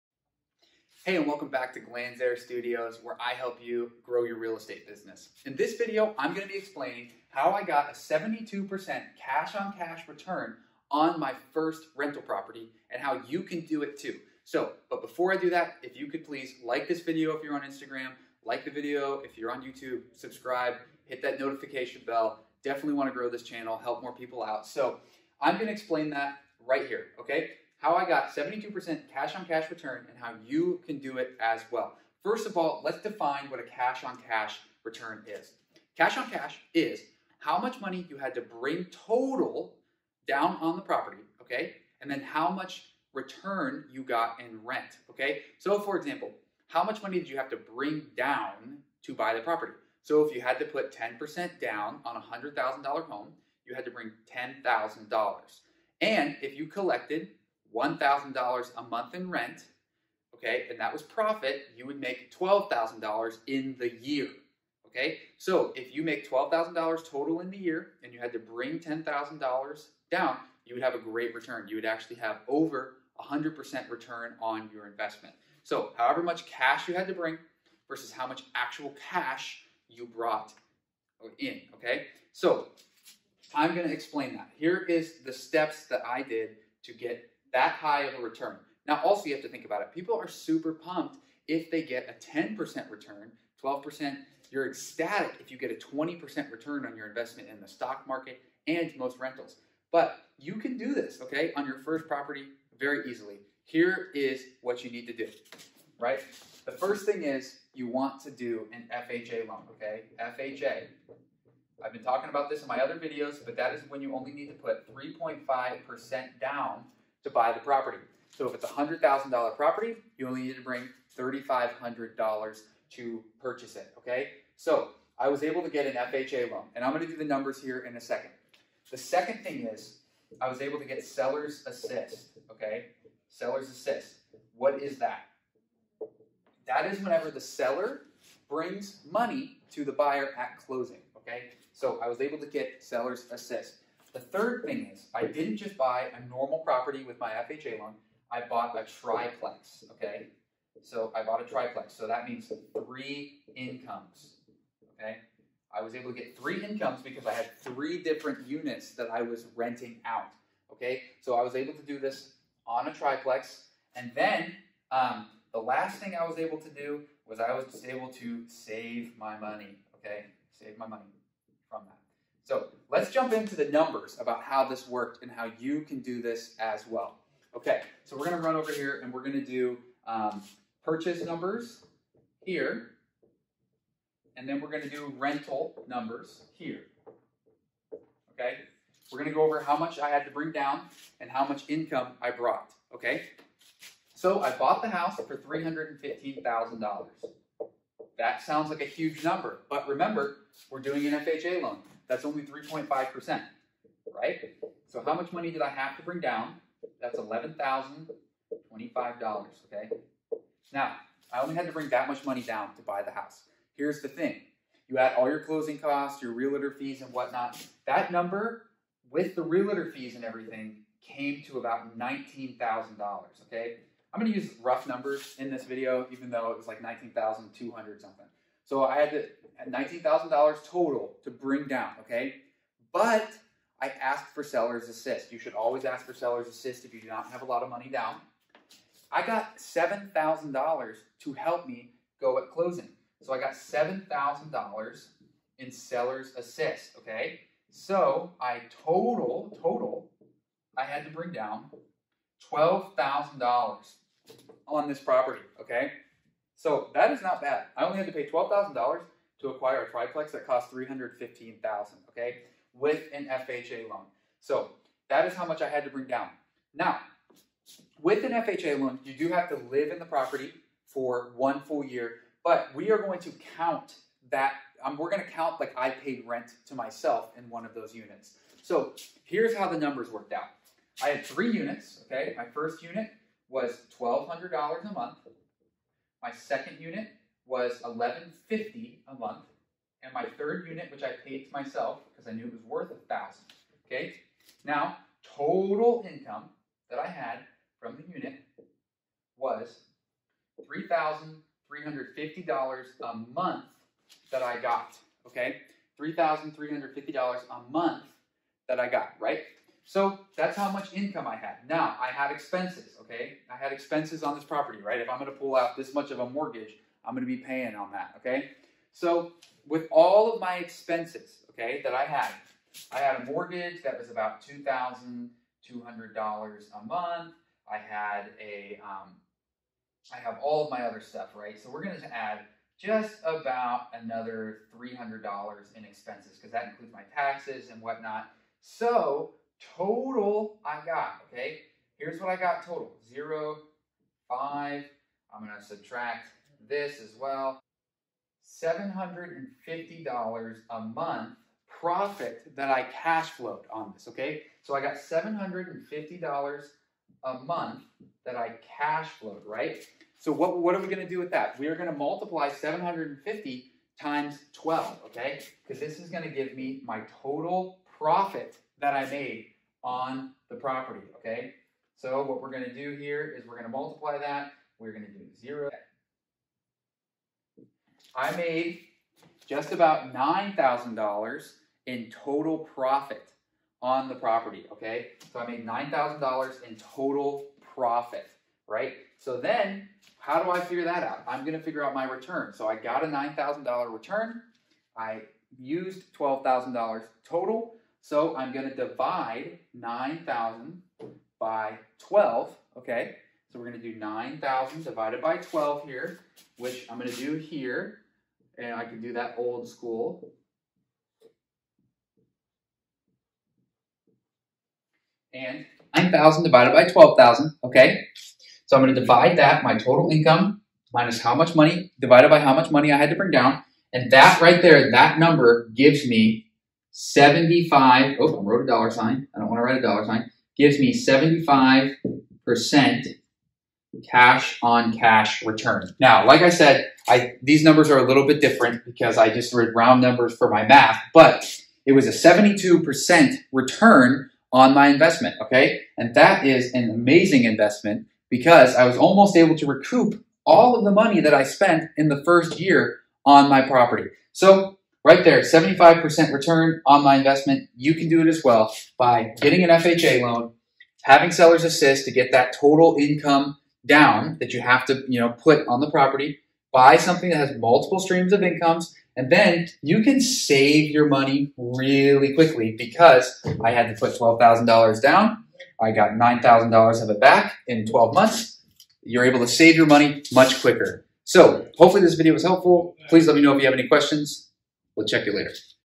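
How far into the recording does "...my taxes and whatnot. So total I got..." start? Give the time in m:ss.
5:36.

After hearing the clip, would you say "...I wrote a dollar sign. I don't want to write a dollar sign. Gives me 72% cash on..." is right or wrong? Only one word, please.
wrong.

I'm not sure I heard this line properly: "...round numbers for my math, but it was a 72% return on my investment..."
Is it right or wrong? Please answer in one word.
right.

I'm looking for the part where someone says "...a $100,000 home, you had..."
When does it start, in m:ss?
0:52.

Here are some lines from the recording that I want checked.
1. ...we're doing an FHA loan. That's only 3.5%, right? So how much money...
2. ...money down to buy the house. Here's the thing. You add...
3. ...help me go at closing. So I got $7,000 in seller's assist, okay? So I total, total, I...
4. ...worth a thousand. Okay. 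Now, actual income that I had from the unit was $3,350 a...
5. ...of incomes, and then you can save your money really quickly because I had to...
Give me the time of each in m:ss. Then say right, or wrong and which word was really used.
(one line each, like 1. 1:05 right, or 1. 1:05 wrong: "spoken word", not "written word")
1. 3:20 right
2. 3:32 right
3. 4:01 right
4. 4:52 wrong: "total", not "actual"
5. 7:48 right.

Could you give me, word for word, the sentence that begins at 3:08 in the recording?
Okay, we're going to go over how much I had to bring down and how much income I brought.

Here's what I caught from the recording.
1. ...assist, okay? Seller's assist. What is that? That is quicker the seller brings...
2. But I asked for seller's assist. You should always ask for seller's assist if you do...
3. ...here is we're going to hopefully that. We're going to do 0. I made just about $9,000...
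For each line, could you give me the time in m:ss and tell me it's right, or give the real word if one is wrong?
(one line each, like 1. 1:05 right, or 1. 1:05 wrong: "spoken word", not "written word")
1. 2:11 wrong: "whenever", not "quicker"
2. 3:52 right
3. 6:12 wrong: "multiply", not "hopefully".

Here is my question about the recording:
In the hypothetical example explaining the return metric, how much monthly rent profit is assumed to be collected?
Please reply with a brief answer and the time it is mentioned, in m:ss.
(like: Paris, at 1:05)
$1,000, at 0:57.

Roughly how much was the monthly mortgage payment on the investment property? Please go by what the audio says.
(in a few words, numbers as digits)
$2,200.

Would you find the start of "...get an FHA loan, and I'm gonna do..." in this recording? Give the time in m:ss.
2:05.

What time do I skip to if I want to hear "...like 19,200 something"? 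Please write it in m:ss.
3:46.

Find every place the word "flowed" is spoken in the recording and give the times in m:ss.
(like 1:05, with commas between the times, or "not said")
5:53, 5:59.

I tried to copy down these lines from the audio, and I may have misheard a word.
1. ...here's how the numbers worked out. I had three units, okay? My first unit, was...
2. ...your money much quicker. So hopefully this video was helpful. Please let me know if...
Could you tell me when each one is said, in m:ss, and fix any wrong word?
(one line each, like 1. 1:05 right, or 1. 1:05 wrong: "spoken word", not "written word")
1. 4:39 right
2. 7:59 right.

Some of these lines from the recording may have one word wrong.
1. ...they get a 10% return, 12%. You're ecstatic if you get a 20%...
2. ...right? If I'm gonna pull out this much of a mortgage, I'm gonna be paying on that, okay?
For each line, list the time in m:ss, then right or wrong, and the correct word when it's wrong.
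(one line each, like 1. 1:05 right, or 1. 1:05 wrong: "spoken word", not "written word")
1. 1:31 right
2. 5:14 right.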